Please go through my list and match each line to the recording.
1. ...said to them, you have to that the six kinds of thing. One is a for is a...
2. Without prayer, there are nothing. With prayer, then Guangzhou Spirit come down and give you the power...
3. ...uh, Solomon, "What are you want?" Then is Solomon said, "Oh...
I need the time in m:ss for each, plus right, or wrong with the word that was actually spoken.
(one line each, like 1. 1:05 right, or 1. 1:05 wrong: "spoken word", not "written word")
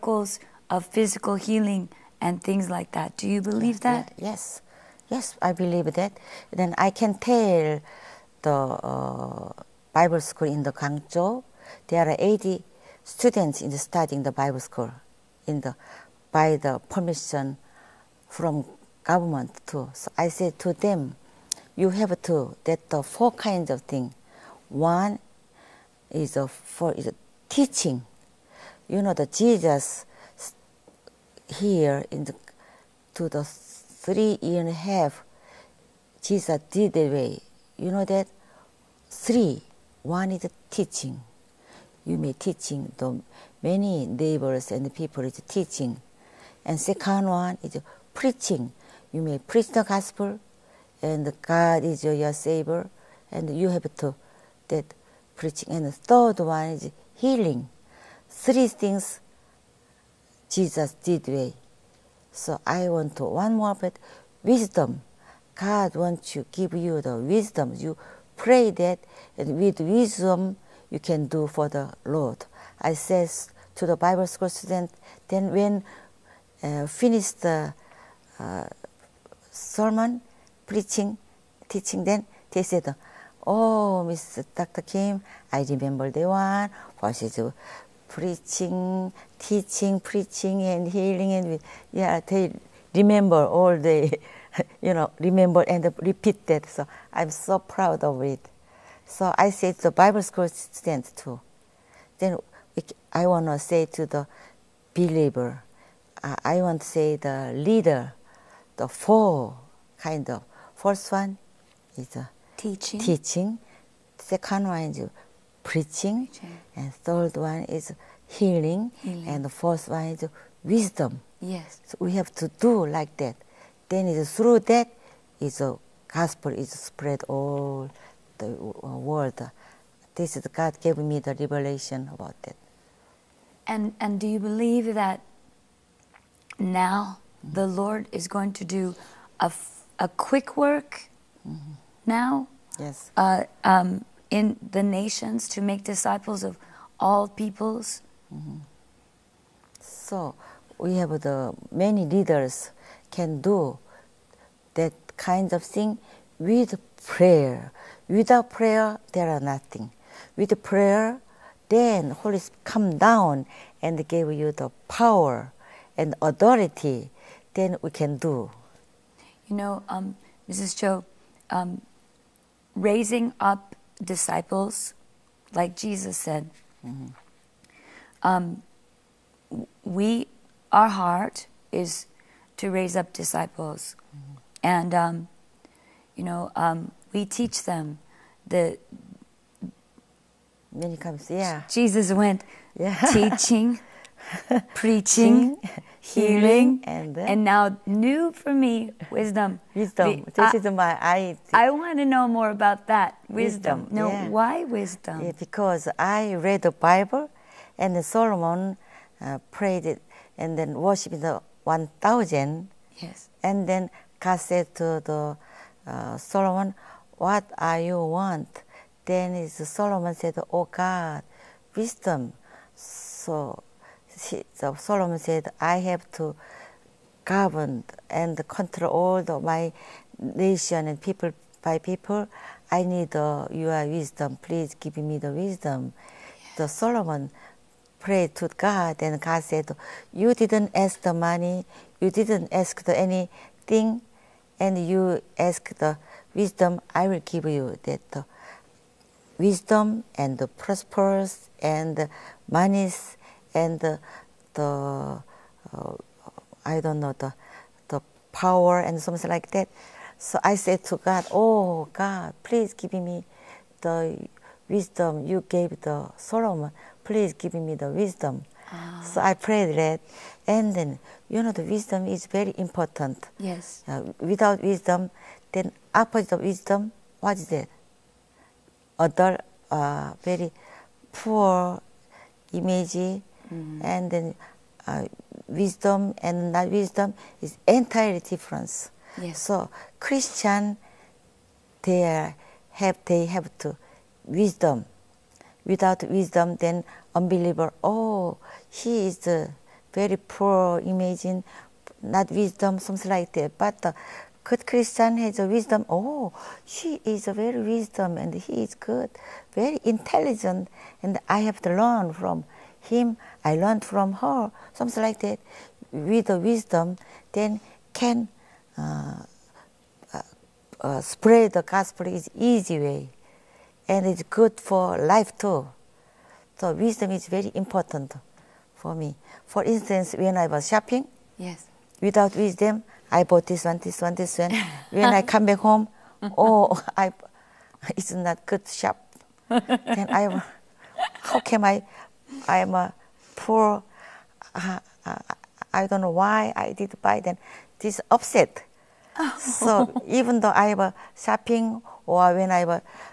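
1. 0:20 wrong: "four", not "six"
2. 2:38 wrong: "Holy", not "Guangzhou"
3. 3:35 right.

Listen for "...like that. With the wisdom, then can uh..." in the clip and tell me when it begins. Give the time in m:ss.
5:15.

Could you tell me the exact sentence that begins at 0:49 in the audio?
You may preach the gospel, and God is your savior, and you have to that preaching.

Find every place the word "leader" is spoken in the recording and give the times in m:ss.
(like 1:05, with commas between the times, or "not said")
1:47, 2:32.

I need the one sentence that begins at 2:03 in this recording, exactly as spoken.
Then it's through that is a gospel is spread all the uh, world.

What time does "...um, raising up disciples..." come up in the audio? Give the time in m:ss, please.
2:51.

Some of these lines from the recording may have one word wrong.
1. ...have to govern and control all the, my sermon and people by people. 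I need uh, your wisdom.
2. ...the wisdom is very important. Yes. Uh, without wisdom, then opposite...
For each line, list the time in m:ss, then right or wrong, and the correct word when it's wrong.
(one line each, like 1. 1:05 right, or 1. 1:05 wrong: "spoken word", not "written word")
1. 3:45 wrong: "nation", not "sermon"
2. 4:31 right.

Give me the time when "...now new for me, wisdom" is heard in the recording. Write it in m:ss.
3:17.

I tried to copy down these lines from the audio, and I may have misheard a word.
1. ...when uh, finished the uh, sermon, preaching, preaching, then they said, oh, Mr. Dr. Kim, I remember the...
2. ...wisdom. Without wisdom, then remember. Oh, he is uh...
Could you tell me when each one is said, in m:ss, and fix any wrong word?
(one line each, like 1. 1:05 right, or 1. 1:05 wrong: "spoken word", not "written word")
1. 1:15 wrong: "teaching", not "preaching"
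2. 4:54 wrong: "unbeliever", not "remember".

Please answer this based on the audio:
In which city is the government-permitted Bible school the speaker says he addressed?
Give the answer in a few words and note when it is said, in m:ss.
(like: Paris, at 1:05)
Guangzhou, at 0:10.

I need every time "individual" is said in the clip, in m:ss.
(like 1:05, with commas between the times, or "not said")
not said.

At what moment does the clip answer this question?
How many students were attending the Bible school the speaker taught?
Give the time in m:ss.
0:12.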